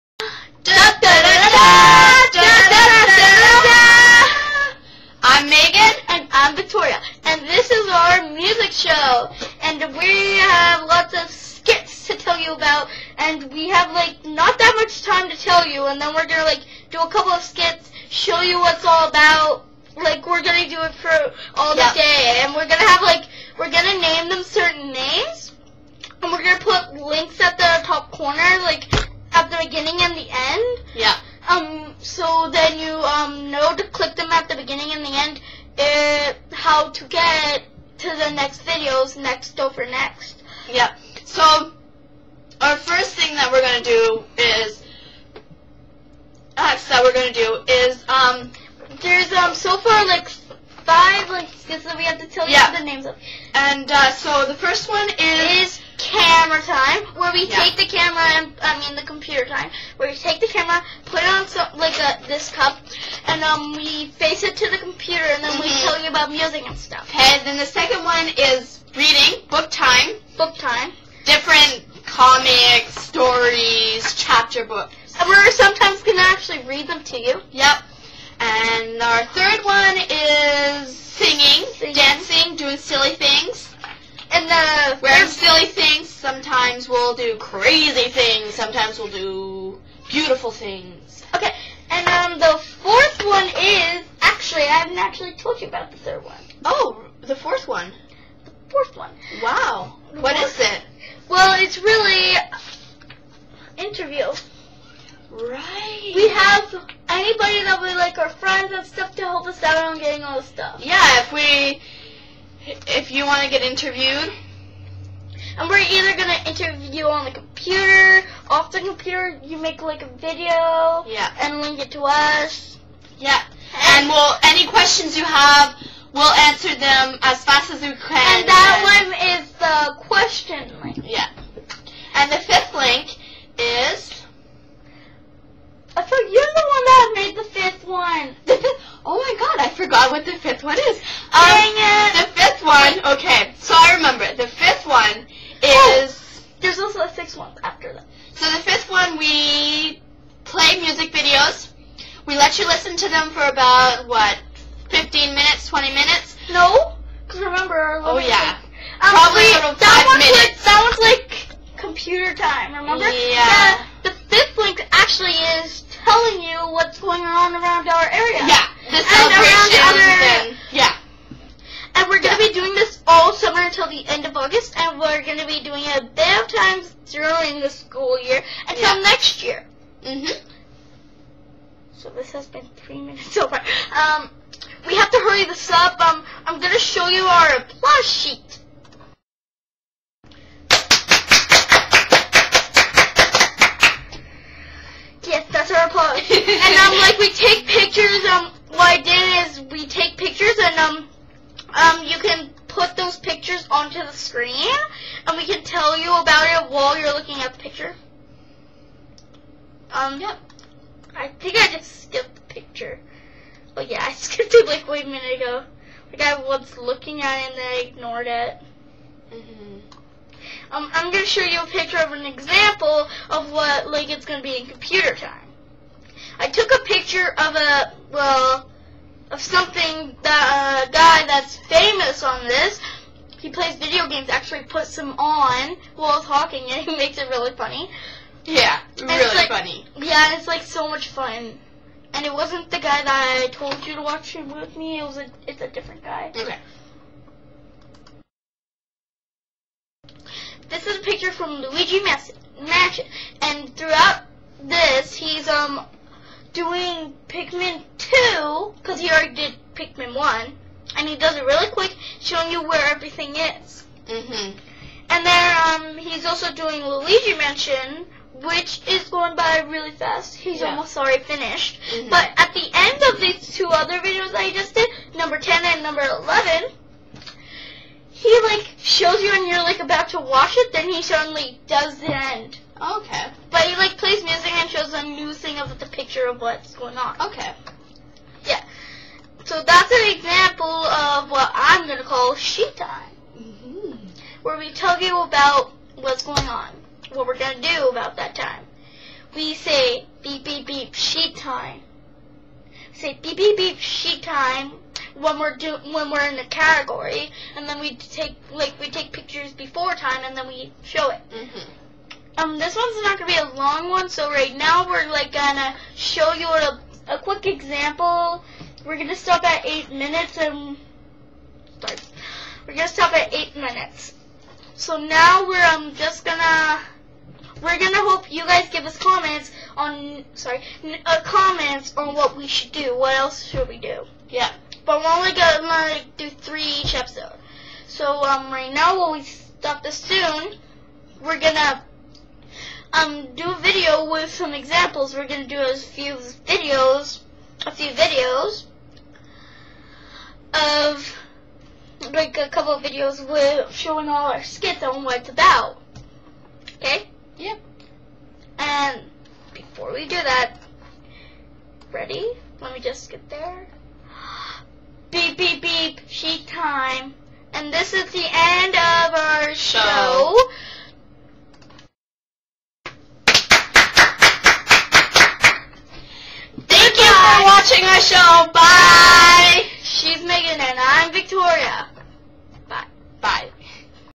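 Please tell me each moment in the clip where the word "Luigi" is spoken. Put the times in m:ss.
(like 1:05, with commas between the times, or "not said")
4:11, 4:26.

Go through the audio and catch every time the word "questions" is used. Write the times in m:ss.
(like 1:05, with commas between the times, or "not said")
2:04, 2:10.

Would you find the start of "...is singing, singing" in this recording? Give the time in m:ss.
1:20.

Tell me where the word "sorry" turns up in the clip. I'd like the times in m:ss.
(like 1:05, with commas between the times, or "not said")
5:21, 5:30.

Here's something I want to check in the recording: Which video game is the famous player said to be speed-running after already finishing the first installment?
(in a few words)
Pikmin 2.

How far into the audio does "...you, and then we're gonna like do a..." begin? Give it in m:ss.
0:15.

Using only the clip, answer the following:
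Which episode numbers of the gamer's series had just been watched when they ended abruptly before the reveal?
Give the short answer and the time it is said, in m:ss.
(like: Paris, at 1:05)
10 and 11, at 4:35.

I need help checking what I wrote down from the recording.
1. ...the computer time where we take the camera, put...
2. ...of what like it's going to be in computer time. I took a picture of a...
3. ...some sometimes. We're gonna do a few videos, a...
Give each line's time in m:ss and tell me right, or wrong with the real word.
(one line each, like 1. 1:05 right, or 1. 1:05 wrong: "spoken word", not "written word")
1. 0:58 right
2. 3:43 right
3. 5:44 wrong: "examples", not "sometimes".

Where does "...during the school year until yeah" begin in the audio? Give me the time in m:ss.
2:57.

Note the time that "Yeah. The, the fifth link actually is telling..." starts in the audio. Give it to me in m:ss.
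2:43.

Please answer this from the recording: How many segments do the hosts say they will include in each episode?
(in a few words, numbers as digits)
3.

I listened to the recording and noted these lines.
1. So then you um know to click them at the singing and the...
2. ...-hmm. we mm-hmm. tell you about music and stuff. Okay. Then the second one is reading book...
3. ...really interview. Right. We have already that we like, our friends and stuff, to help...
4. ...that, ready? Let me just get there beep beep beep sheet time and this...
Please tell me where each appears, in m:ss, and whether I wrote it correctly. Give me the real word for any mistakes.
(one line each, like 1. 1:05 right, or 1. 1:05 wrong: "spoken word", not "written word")
1. 0:31 wrong: "beginning", not "singing"
2. 1:05 right
3. 1:41 wrong: "anybody", not "already"
4. 6:00 right.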